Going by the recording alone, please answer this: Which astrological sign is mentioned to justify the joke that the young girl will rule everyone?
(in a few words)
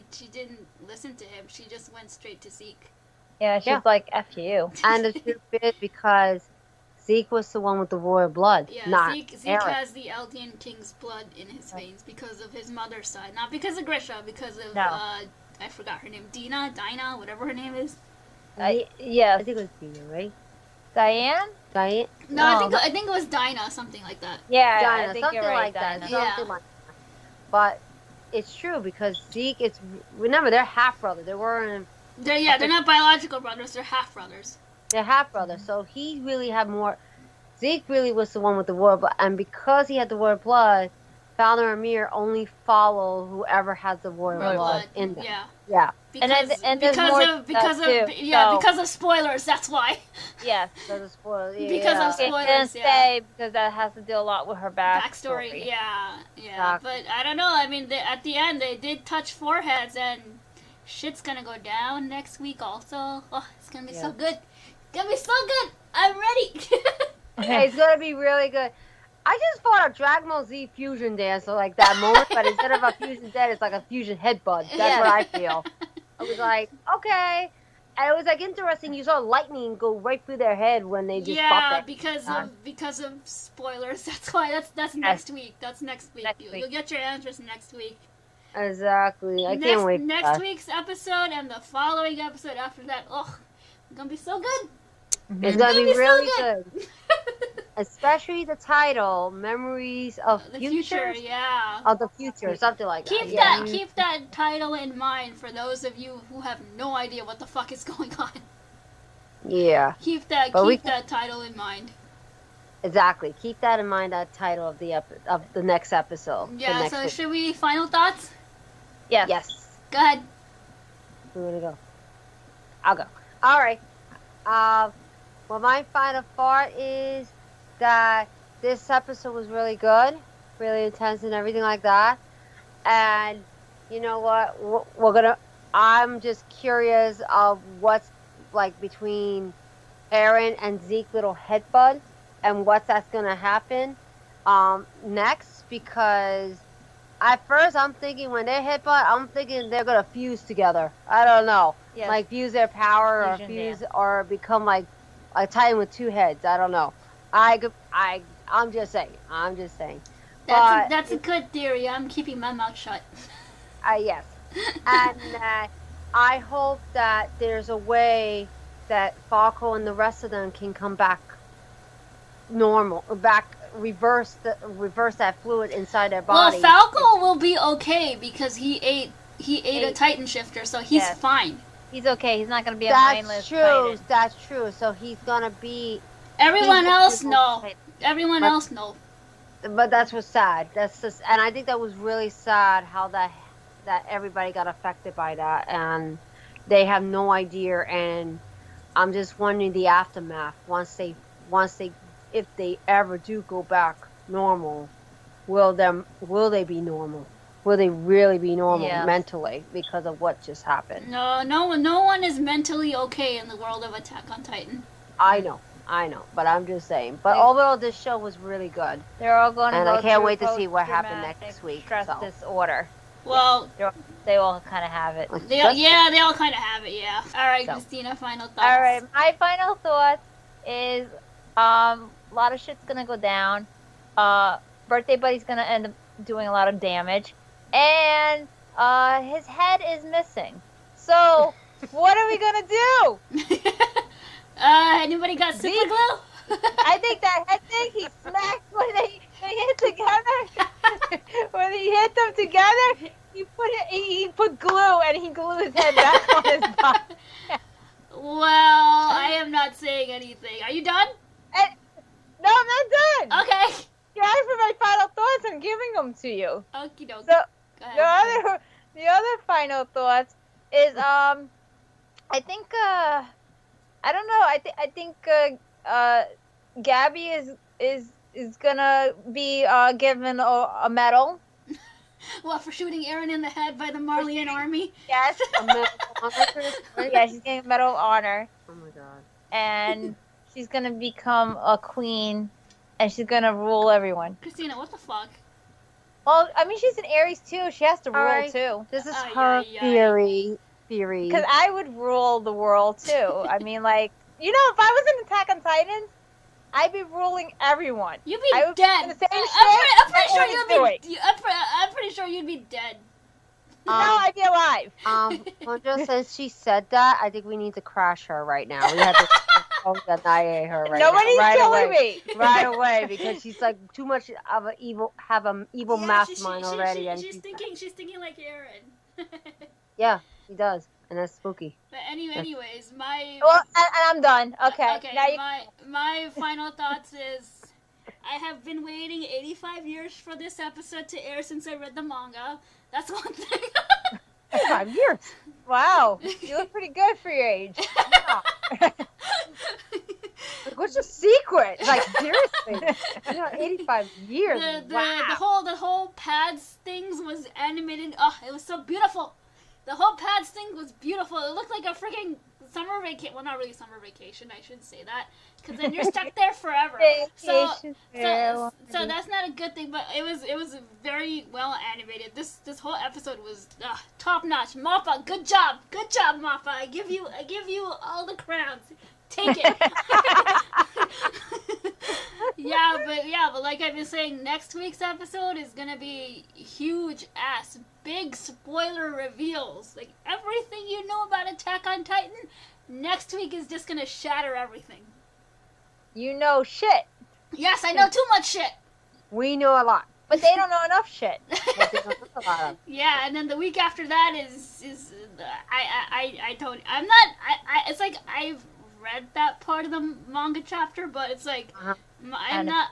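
Aries.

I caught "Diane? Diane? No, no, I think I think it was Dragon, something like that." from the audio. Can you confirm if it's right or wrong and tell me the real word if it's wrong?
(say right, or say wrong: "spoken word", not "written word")
wrong: "Dinah", not "Dragon".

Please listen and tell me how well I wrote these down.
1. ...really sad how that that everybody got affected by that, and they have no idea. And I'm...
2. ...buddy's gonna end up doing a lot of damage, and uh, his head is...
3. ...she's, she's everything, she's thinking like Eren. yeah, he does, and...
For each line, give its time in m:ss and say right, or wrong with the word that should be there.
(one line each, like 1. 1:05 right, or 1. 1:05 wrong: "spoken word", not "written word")
1. 3:11 right
2. 3:55 right
3. 5:27 wrong: "thinking", not "everything".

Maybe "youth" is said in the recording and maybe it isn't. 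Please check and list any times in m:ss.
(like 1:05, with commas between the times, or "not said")
not said.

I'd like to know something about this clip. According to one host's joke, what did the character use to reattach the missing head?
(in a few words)
super glue.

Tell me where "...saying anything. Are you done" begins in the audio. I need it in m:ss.
4:19.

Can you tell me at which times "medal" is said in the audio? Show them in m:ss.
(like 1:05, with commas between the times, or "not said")
4:40, 4:47.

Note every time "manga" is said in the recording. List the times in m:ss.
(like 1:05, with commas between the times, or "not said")
5:42, 6:50.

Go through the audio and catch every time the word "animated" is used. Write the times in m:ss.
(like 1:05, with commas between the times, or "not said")
5:57, 6:11.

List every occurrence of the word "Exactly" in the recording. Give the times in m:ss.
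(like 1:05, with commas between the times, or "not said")
1:28, 1:52.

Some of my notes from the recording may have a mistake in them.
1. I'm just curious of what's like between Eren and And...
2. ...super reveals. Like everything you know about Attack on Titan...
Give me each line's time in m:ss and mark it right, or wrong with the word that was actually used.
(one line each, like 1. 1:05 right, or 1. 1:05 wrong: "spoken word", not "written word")
1. 2:15 wrong: "Zeke", not "And"
2. 6:28 wrong: "spoiler", not "super".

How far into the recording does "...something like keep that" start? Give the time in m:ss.
1:42.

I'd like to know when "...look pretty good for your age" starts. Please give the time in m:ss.
5:46.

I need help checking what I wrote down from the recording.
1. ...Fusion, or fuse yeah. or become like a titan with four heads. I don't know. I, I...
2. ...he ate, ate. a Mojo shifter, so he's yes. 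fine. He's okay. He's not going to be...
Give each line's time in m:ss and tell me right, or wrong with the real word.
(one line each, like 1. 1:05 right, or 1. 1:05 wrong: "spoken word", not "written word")
1. 2:33 wrong: "two", not "four"
2. 2:59 wrong: "Titan", not "Mojo".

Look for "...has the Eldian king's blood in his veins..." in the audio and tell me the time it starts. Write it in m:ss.
0:09.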